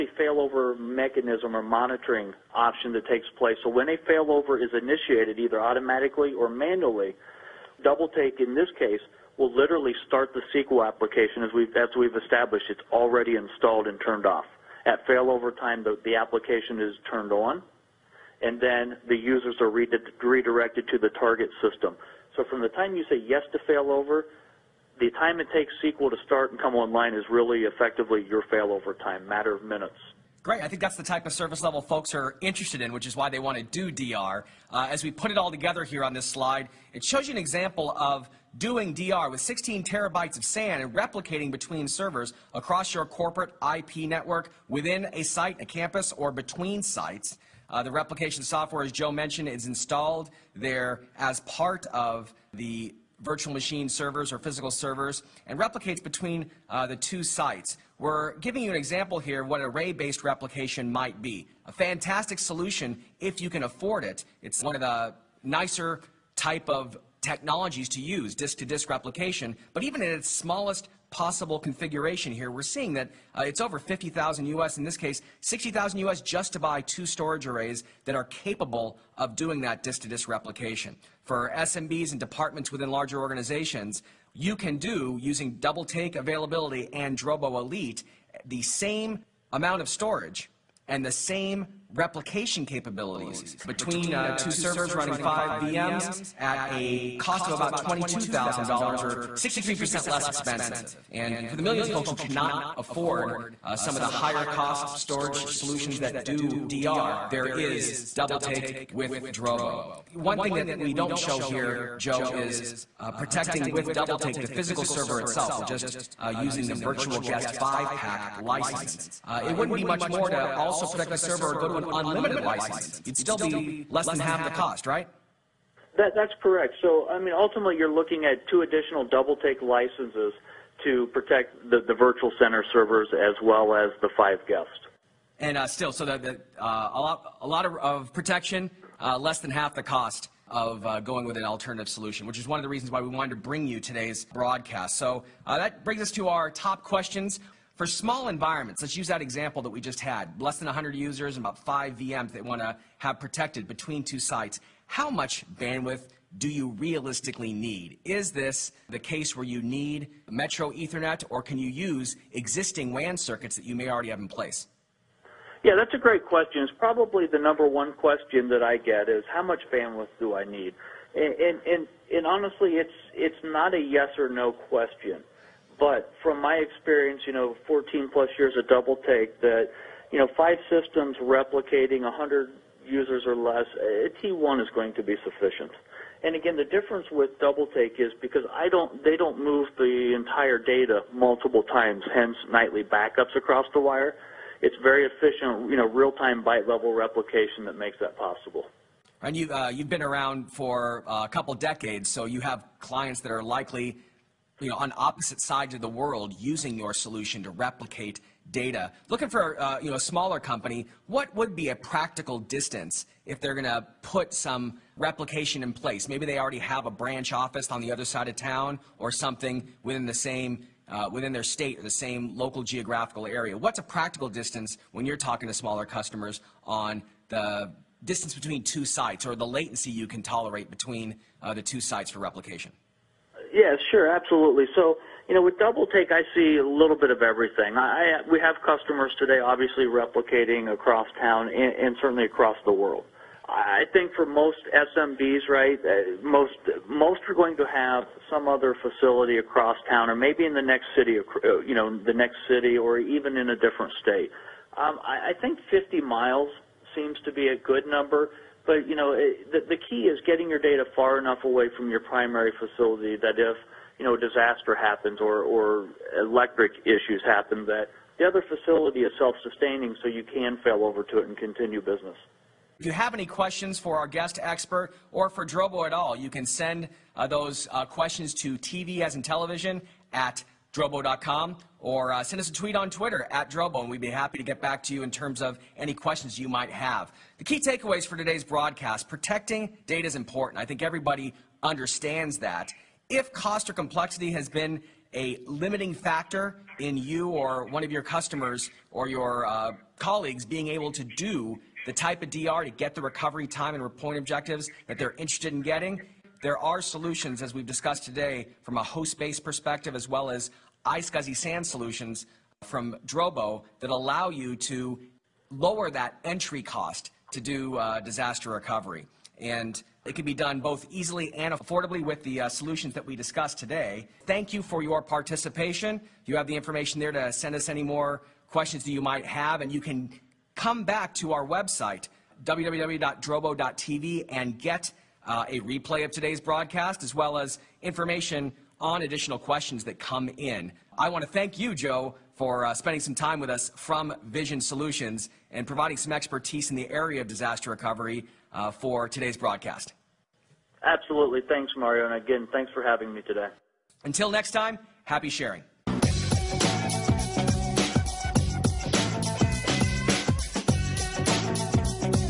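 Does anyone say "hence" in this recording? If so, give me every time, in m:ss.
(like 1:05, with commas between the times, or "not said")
3:12.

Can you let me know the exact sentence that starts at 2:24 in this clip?
So uh, that brings us to our top questions.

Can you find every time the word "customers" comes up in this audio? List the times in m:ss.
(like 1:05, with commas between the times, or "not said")
3:45, 3:58, 4:58.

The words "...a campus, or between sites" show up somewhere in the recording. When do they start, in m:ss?
0:45.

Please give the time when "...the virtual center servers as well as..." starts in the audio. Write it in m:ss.
2:11.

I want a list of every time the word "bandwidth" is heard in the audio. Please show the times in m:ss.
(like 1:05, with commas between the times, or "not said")
2:35, 2:49.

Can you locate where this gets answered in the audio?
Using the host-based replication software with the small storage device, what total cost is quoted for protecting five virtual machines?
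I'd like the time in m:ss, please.
1:37.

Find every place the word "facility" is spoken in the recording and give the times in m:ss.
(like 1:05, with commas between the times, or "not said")
4:08, 4:22, 4:28.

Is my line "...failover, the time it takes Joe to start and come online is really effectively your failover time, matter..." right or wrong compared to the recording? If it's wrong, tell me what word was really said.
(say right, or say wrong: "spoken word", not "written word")
wrong: "SQL", not "Joe".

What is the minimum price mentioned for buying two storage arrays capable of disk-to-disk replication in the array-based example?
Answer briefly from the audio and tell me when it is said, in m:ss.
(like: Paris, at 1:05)
$60,000, at 1:15.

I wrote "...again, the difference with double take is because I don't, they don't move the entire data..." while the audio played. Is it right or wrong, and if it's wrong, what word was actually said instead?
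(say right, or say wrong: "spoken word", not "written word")
right.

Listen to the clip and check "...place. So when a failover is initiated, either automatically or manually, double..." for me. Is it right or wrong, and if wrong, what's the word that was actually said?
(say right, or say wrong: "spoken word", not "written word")
right.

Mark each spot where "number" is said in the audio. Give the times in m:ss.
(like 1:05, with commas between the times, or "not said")
2:47, 4:17.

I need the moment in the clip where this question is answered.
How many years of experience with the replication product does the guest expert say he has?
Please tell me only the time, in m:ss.
2:57.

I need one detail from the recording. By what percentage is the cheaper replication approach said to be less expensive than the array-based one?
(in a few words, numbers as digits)
63%.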